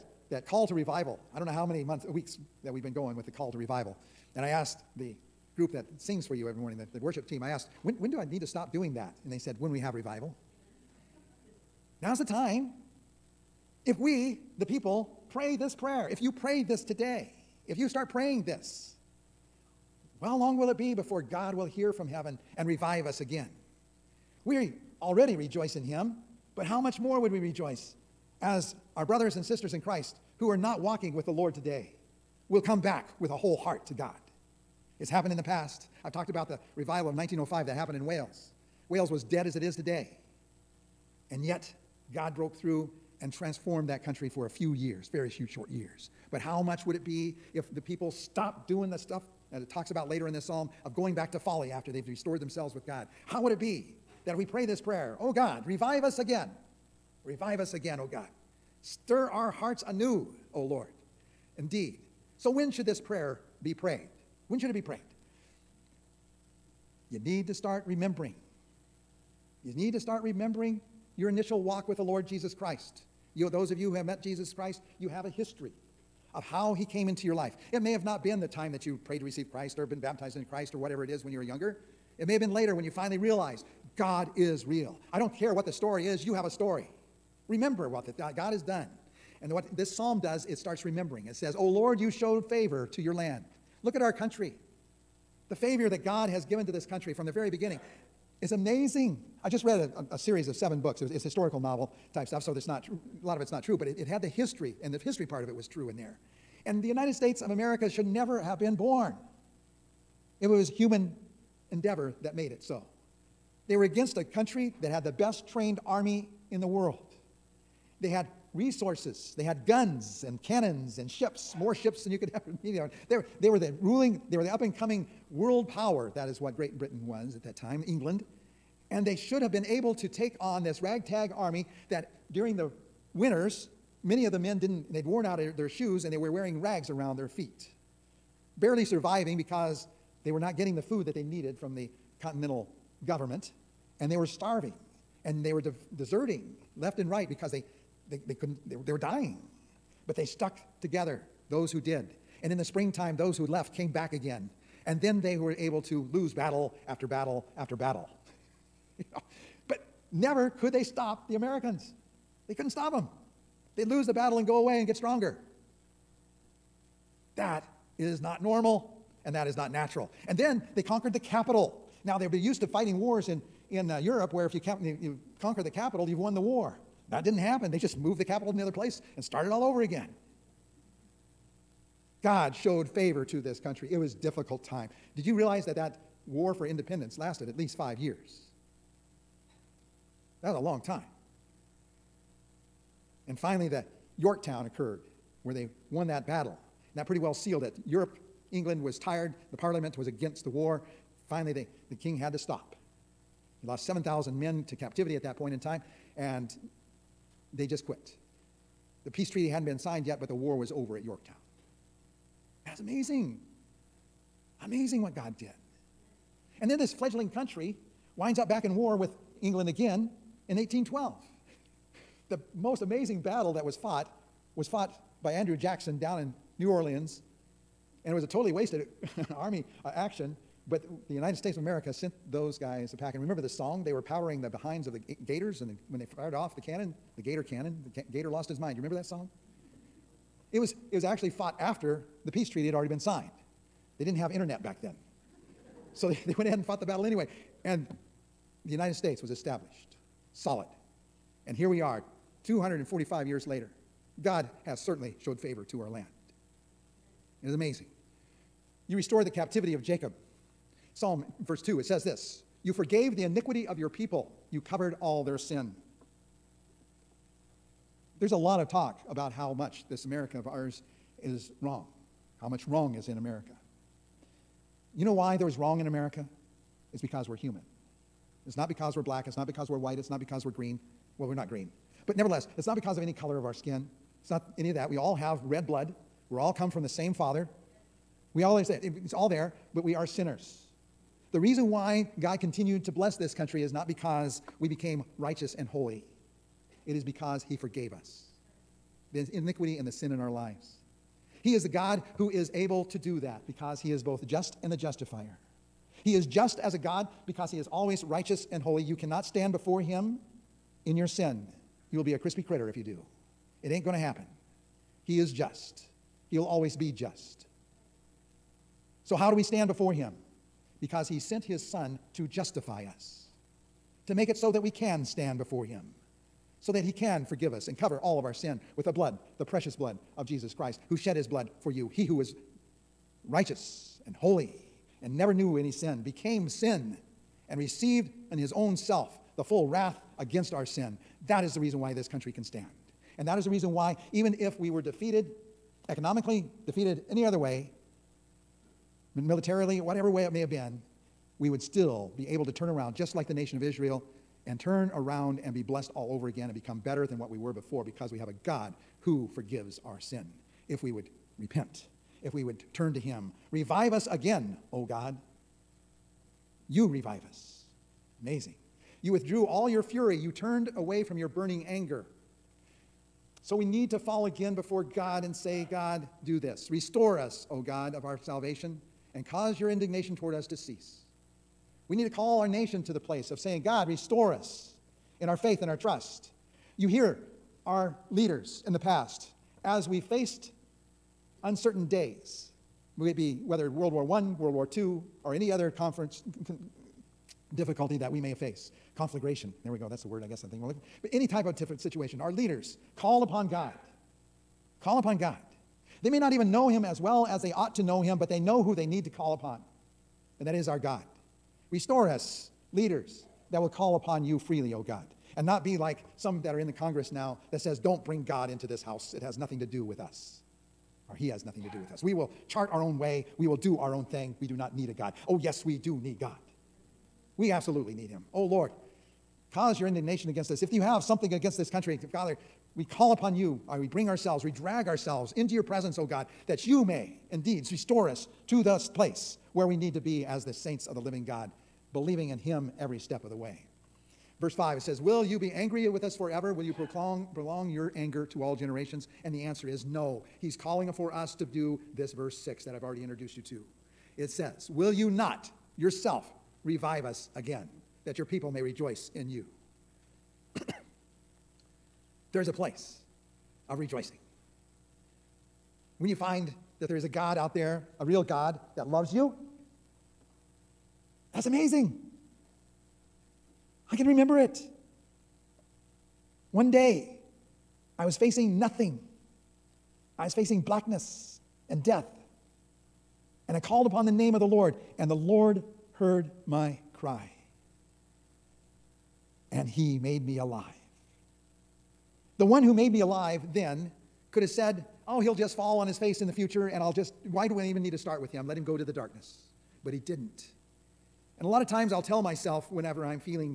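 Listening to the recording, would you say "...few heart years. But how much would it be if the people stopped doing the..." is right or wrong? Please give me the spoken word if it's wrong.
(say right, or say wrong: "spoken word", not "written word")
wrong: "short", not "heart".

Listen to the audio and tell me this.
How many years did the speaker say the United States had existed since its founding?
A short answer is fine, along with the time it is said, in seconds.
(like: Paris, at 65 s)
245, at 252 s.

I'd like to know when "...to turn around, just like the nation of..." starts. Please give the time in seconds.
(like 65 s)
352 s.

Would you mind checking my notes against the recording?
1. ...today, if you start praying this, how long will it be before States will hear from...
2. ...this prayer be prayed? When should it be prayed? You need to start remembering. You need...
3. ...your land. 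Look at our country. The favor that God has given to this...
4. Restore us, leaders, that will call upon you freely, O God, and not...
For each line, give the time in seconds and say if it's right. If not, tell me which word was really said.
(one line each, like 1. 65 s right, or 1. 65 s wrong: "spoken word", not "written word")
1. 16 s wrong: "God", not "States"
2. 62 s right
3. 93 s right
4. 411 s right.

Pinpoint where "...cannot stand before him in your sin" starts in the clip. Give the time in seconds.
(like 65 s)
308 s.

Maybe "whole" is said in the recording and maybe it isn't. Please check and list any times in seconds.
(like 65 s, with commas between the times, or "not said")
33 s.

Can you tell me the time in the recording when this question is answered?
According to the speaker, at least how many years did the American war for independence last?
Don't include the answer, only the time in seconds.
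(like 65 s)
187 s.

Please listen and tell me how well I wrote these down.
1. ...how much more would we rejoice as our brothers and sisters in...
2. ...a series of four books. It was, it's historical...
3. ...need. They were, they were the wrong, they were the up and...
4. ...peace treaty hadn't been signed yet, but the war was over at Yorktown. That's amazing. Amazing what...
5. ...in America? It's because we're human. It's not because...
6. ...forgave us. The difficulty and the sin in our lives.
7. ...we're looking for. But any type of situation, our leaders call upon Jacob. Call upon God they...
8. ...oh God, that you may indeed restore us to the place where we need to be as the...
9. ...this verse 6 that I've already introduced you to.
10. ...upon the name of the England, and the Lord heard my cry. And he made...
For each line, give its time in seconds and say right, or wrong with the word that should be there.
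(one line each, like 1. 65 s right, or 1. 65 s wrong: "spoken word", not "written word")
1. 26 s right
2. 100 s wrong: "seven", not "four"
3. 122 s wrong: "ruling", not "wrong"
4. 209 s right
5. 275 s right
6. 297 s wrong: "iniquity", not "difficulty"
7. 400 s wrong: "God", not "Jacob"
8. 436 s right
9. 451 s right
10. 483 s wrong: "Lord", not "England".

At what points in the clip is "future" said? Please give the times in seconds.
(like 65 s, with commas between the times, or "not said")
496 s.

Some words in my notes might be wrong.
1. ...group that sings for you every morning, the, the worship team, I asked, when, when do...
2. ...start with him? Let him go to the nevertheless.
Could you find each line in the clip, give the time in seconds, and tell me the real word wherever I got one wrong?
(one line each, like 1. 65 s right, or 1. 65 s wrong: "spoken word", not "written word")
1. 5 s right
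2. 497 s wrong: "darkness", not "nevertheless".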